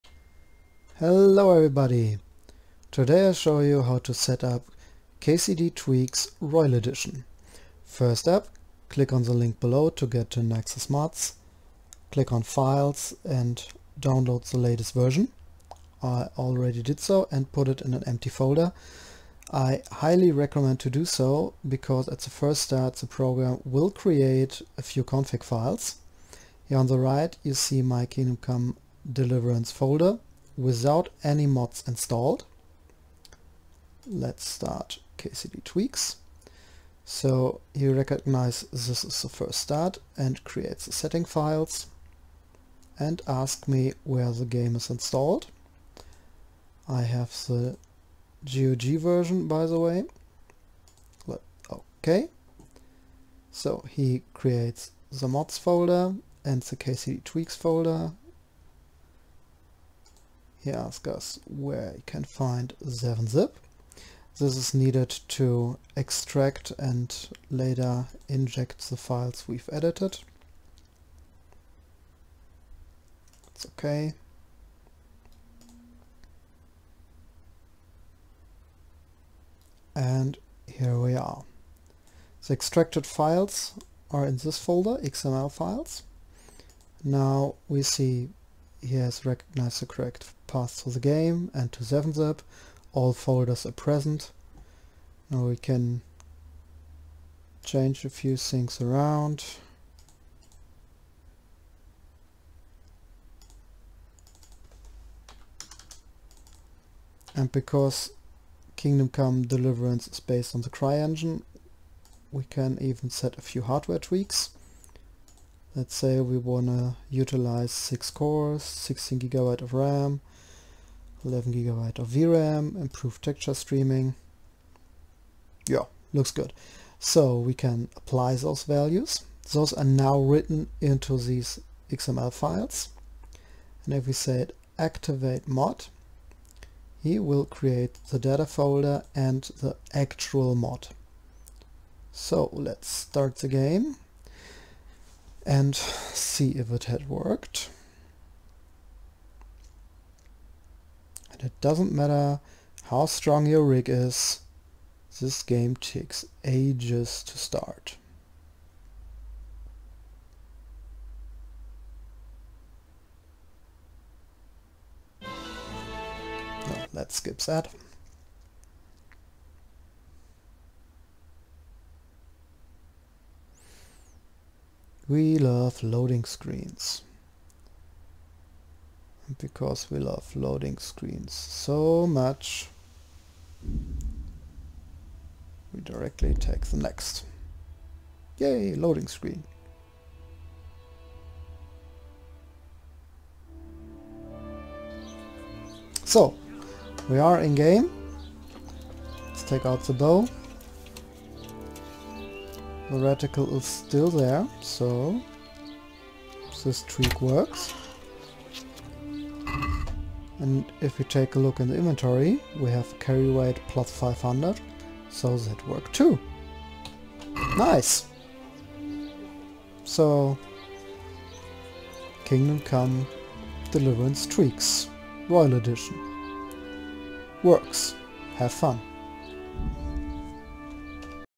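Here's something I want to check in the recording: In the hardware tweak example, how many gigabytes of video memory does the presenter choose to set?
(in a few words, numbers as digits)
11.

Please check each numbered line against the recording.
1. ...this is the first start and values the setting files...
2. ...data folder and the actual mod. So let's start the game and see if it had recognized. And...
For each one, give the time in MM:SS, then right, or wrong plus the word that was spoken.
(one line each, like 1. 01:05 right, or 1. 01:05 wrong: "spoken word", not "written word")
1. 00:38 wrong: "creates", not "values"
2. 02:18 wrong: "worked", not "recognized".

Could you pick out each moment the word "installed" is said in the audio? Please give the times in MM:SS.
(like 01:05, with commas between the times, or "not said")
00:31, 00:44.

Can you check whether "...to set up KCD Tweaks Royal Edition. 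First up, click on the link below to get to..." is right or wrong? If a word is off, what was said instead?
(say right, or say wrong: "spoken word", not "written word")
right.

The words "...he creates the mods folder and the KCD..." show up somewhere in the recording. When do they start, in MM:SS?
00:53.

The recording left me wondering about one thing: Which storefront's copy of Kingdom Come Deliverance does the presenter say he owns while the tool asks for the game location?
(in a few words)
GOG.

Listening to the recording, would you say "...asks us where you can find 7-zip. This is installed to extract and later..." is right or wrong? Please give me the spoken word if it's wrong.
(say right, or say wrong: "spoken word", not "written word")
wrong: "needed", not "installed".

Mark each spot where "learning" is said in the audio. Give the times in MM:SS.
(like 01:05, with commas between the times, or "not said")
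not said.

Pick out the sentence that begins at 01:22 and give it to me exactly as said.
The extracted files are in this folder, XML files.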